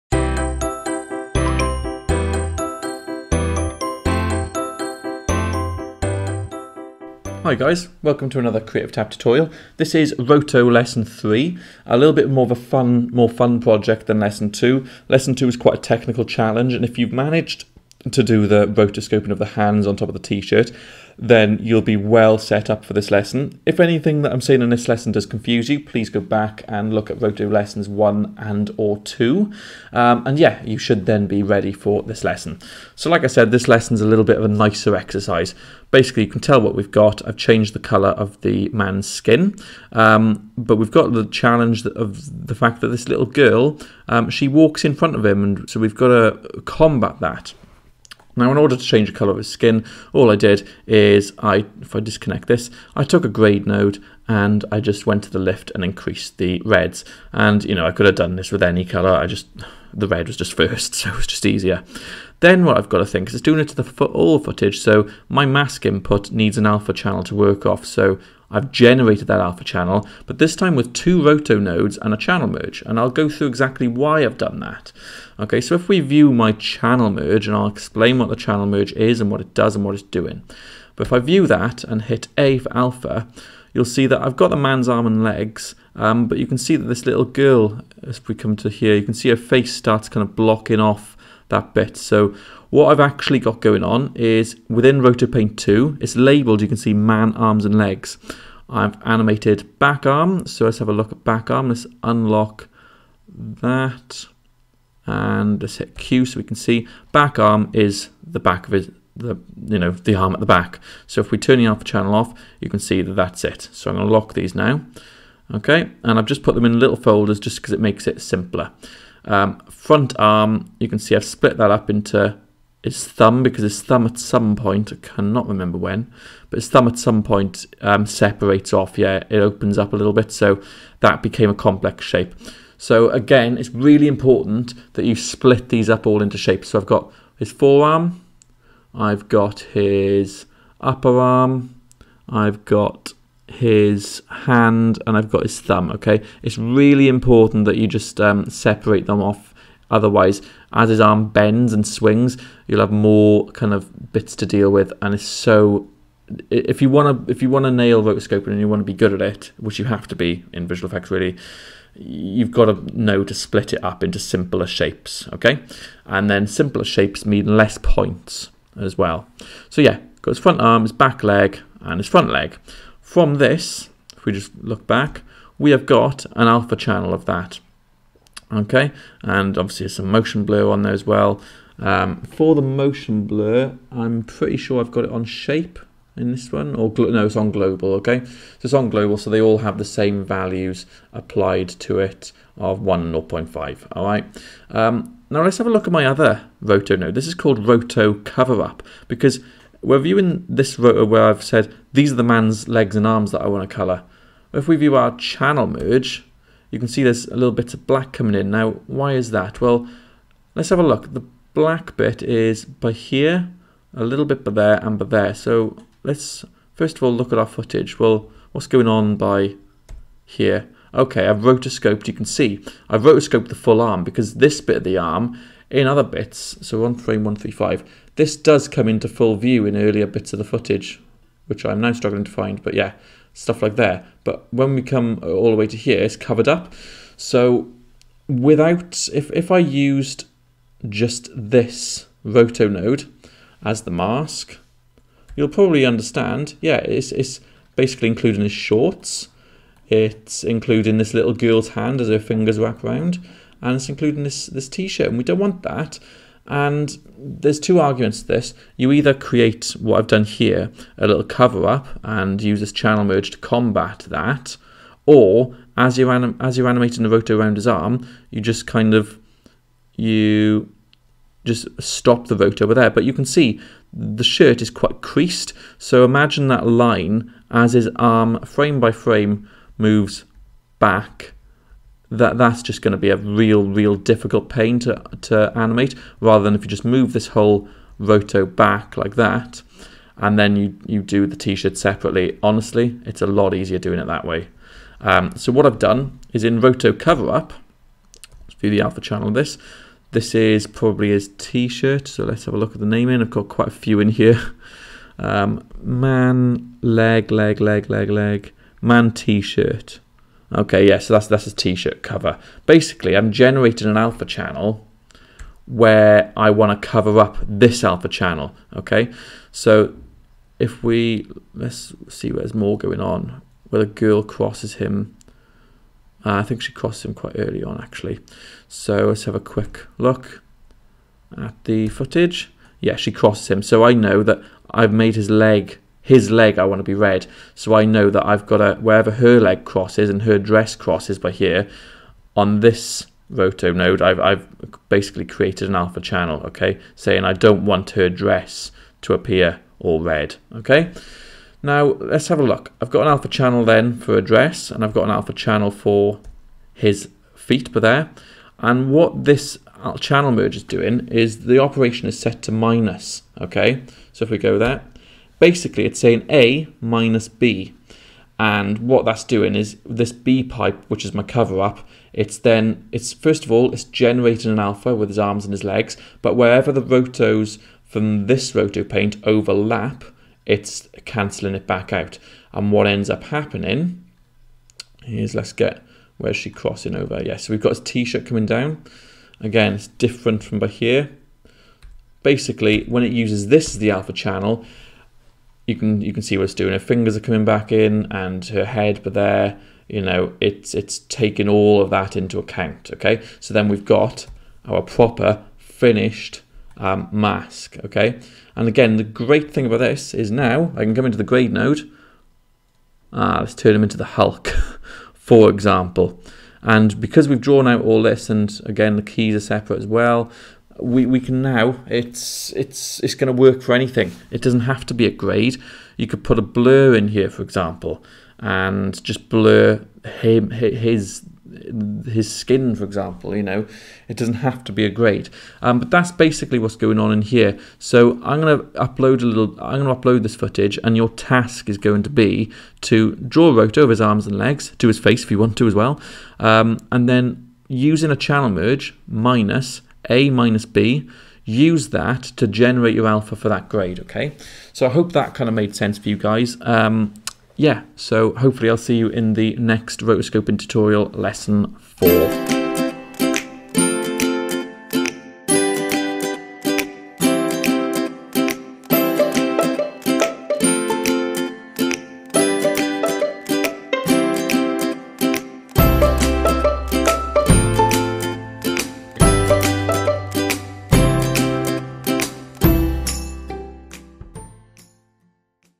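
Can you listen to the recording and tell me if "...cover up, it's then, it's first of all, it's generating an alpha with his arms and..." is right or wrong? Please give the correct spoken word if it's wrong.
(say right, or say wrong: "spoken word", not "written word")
right.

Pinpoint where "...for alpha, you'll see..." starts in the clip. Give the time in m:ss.
1:22.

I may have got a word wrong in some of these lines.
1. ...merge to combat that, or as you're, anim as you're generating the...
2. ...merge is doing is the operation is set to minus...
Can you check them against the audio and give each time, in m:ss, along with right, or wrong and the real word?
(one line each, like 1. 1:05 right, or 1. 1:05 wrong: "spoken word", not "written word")
1. 4:23 wrong: "animating", not "generating"
2. 6:00 right.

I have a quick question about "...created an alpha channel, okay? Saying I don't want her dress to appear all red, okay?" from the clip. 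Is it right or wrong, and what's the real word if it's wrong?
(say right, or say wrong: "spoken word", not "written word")
right.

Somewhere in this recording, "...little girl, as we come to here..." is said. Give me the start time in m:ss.
1:27.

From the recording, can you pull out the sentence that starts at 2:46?
And then simpler shapes mean less points as well.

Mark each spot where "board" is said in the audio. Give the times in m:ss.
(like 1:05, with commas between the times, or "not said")
not said.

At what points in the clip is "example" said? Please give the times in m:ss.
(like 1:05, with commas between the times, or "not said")
6:55, 7:07, 7:12.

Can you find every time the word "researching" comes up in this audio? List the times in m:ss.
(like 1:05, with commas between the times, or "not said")
not said.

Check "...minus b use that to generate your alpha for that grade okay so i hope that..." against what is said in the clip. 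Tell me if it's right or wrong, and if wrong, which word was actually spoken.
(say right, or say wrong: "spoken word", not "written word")
right.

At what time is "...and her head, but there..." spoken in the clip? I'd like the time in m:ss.
6:38.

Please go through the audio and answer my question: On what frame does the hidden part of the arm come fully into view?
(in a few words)
135.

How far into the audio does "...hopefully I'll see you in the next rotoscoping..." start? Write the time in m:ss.
7:38.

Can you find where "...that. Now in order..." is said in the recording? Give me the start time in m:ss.
0:47.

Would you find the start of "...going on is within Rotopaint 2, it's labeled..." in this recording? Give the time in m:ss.
1:33.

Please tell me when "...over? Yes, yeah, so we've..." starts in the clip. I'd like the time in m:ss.
6:26.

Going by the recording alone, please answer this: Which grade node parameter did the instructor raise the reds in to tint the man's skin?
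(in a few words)
Lift.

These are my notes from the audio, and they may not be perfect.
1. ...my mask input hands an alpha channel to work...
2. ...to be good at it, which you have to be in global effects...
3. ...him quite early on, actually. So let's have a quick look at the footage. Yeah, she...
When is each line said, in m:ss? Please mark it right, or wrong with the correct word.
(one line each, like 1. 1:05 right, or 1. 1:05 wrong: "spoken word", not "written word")
1. 1:05 wrong: "needs", not "hands"
2. 2:38 wrong: "visual", not "global"
3. 5:27 right.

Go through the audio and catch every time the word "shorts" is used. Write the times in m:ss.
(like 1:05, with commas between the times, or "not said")
4:08.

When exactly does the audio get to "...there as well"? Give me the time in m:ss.
3:00.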